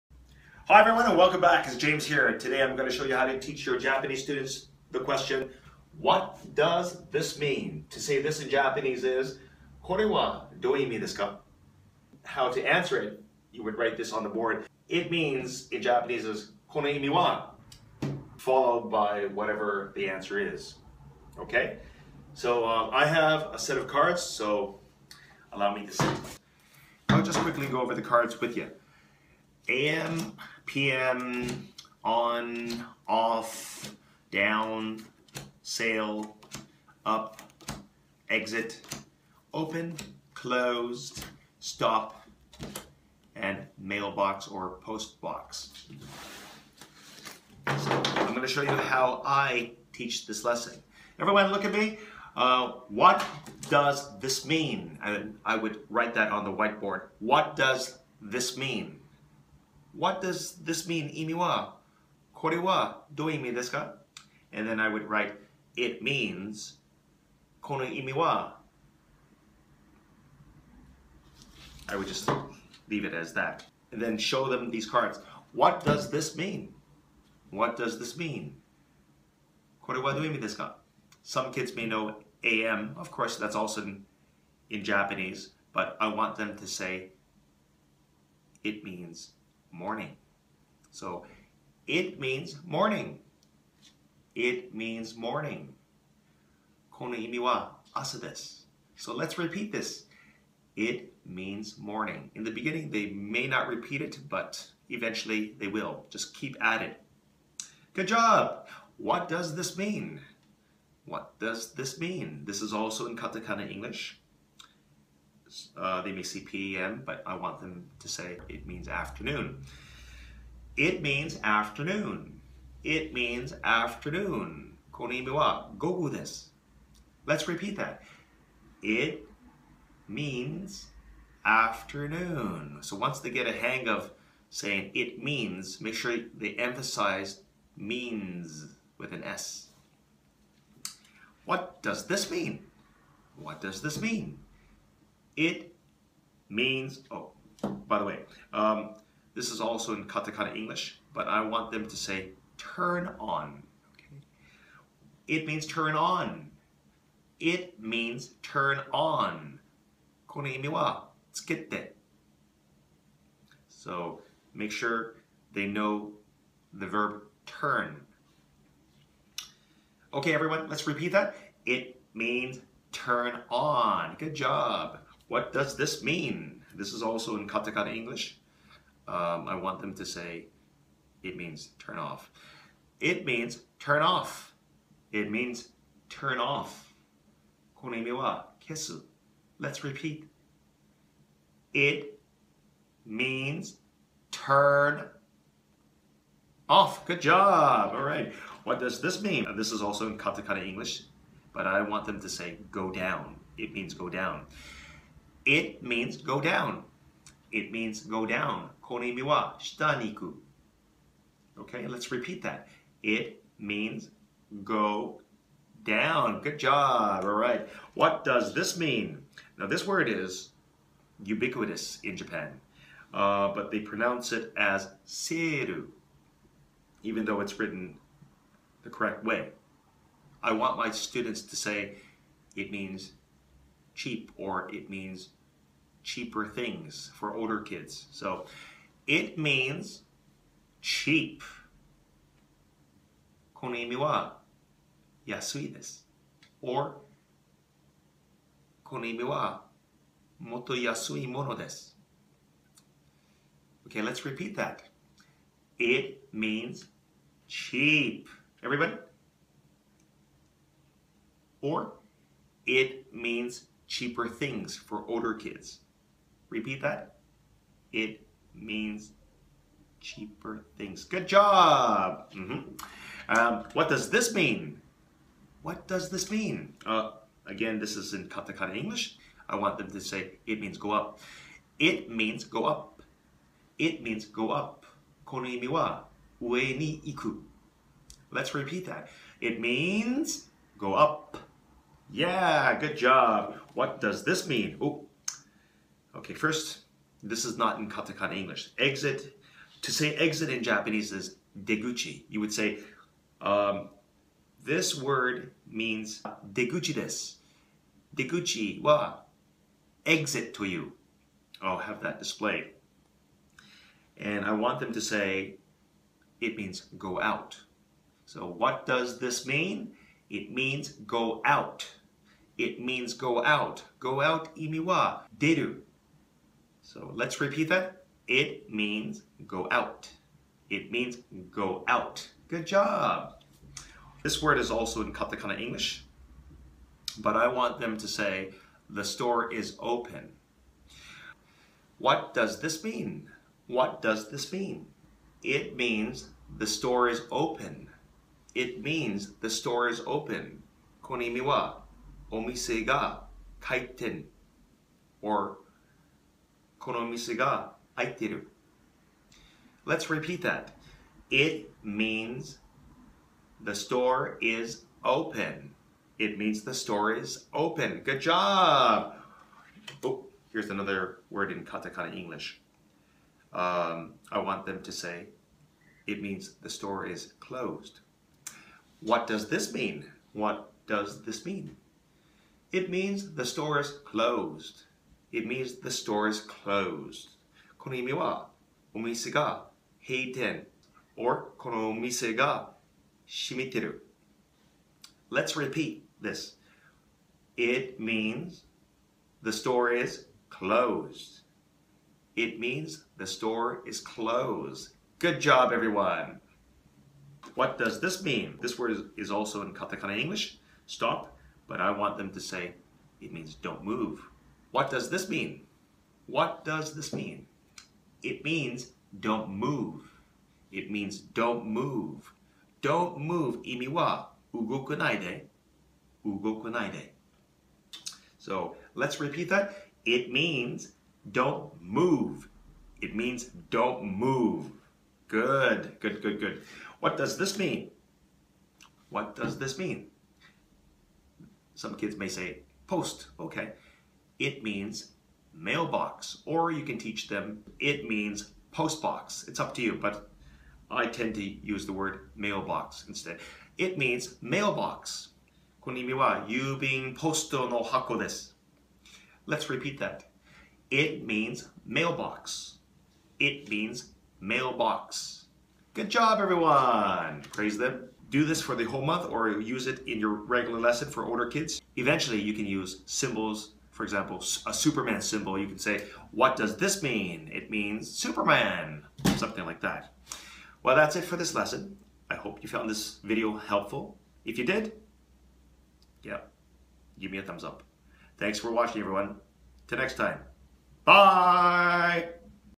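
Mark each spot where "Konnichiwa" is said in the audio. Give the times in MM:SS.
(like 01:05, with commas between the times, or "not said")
02:04, 05:51.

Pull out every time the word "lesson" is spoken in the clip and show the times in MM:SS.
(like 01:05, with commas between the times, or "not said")
00:50, 07:50, 08:01.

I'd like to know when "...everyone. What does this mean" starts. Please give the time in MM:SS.
06:45.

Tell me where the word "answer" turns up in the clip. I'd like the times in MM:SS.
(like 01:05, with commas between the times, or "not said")
00:12, 00:20.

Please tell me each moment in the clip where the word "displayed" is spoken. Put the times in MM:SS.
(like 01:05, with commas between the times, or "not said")
05:12.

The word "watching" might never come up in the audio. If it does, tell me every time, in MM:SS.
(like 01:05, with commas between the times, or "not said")
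08:08.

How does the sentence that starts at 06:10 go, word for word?
Oh, here's another word in katakana English um, I want them to say it means the store is closed.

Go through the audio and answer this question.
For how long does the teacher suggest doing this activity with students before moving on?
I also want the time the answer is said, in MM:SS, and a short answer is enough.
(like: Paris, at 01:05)
the whole month, at 07:48.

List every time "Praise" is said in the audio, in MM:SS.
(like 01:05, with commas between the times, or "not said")
07:47.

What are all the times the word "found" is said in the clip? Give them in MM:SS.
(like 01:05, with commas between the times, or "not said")
08:02.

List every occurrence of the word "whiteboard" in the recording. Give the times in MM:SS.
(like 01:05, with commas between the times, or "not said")
00:56.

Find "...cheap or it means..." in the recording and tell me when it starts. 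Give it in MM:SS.
03:54.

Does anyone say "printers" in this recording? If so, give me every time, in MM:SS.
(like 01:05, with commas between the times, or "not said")
not said.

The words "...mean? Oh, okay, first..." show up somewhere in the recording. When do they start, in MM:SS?
04:54.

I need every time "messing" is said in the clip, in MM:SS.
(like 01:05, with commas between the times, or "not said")
not said.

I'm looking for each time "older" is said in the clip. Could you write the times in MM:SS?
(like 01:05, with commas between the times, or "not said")
03:57, 04:25, 07:51.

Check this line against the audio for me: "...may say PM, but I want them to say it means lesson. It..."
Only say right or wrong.
wrong.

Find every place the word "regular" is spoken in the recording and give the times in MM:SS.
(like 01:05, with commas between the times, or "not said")
07:50.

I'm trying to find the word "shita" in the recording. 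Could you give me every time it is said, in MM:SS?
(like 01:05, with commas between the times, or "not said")
03:29.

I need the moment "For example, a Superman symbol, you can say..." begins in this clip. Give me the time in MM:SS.
07:53.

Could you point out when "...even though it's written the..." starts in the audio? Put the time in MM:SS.
03:47.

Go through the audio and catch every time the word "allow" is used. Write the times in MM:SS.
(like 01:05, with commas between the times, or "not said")
00:25.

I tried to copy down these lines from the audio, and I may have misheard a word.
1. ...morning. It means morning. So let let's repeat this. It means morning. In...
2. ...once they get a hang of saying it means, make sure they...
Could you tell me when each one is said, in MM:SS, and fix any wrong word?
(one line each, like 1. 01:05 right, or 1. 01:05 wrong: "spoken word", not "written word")
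1. 01:32 right
2. 02:12 right.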